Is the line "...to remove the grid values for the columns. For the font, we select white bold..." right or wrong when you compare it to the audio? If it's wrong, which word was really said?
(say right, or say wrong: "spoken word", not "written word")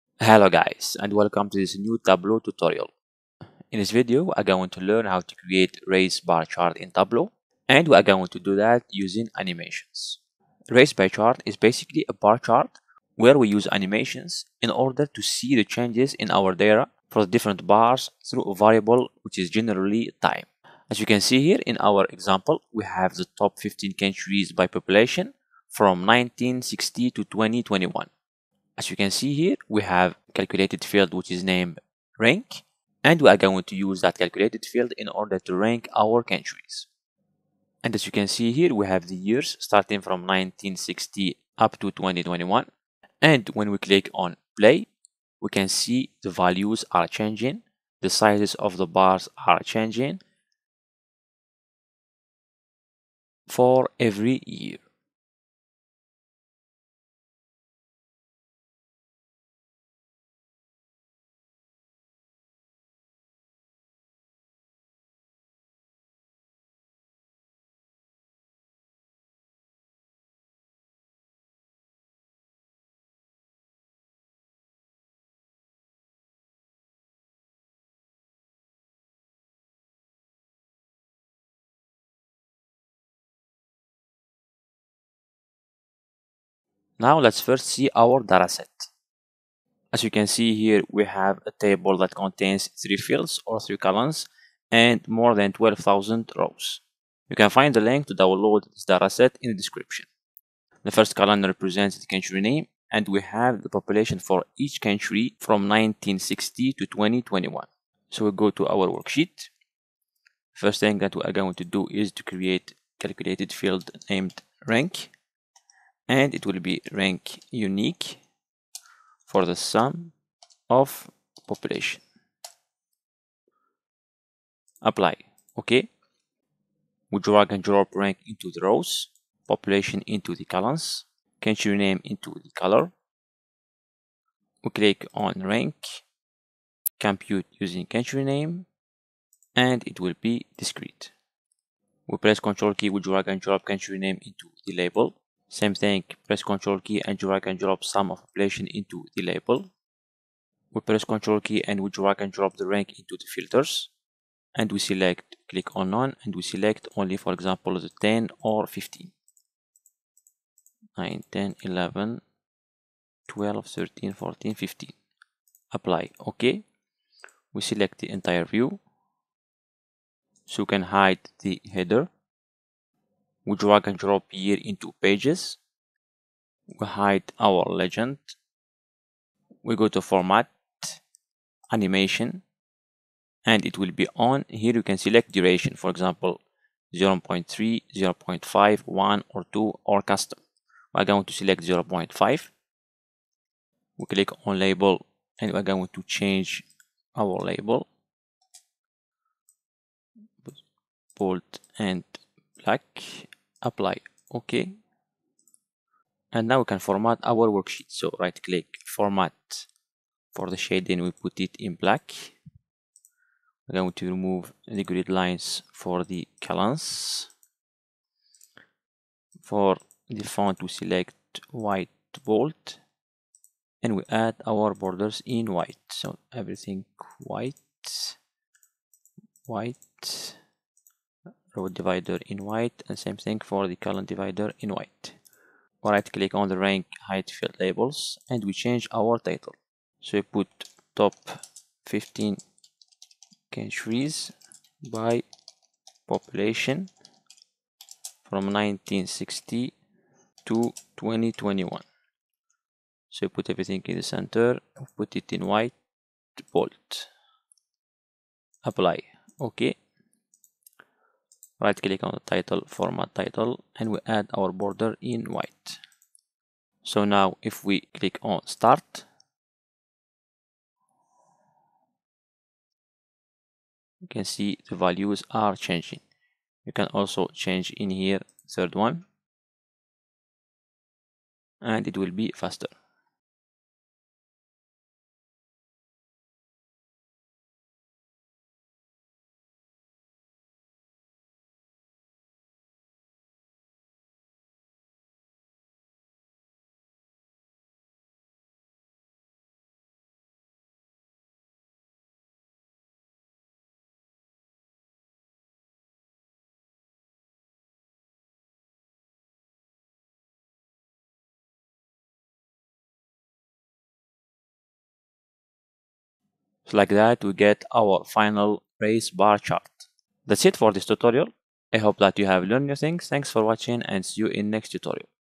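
wrong: "lines", not "values".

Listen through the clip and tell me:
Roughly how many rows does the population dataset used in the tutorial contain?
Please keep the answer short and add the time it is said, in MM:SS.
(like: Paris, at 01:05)
More than 12,000, at 01:35.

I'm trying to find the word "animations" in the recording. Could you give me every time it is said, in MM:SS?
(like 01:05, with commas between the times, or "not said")
00:09, 00:13, 03:01.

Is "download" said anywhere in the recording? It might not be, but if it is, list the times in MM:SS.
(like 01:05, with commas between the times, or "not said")
01:38.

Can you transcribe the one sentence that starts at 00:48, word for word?
The sizes of the bars are changing for every year.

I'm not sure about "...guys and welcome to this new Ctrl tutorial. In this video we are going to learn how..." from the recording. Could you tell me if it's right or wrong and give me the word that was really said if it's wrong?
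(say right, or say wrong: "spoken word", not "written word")
wrong: "Tableau", not "Ctrl".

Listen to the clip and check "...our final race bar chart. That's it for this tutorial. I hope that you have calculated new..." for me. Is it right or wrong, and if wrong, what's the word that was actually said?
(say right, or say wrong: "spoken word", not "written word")
wrong: "learned", not "calculated".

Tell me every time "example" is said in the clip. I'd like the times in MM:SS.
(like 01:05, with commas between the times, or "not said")
00:22, 02:37, 03:05.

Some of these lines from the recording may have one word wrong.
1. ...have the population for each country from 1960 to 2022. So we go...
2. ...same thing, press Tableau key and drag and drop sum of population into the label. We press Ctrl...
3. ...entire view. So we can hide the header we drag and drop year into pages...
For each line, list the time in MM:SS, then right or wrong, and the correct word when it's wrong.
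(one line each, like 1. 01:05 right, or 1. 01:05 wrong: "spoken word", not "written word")
1. 01:43 wrong: "2021", not "2022"
2. 02:25 wrong: "Ctrl", not "Tableau"
3. 02:48 right.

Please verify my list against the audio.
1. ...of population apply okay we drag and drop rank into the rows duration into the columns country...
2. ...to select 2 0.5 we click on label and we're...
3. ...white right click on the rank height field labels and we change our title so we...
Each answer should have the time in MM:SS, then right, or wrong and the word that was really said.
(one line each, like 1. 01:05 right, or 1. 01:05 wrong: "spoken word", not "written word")
1. 02:00 wrong: "population", not "duration"
2. 03:11 wrong: "0", not "2"
3. 03:54 right.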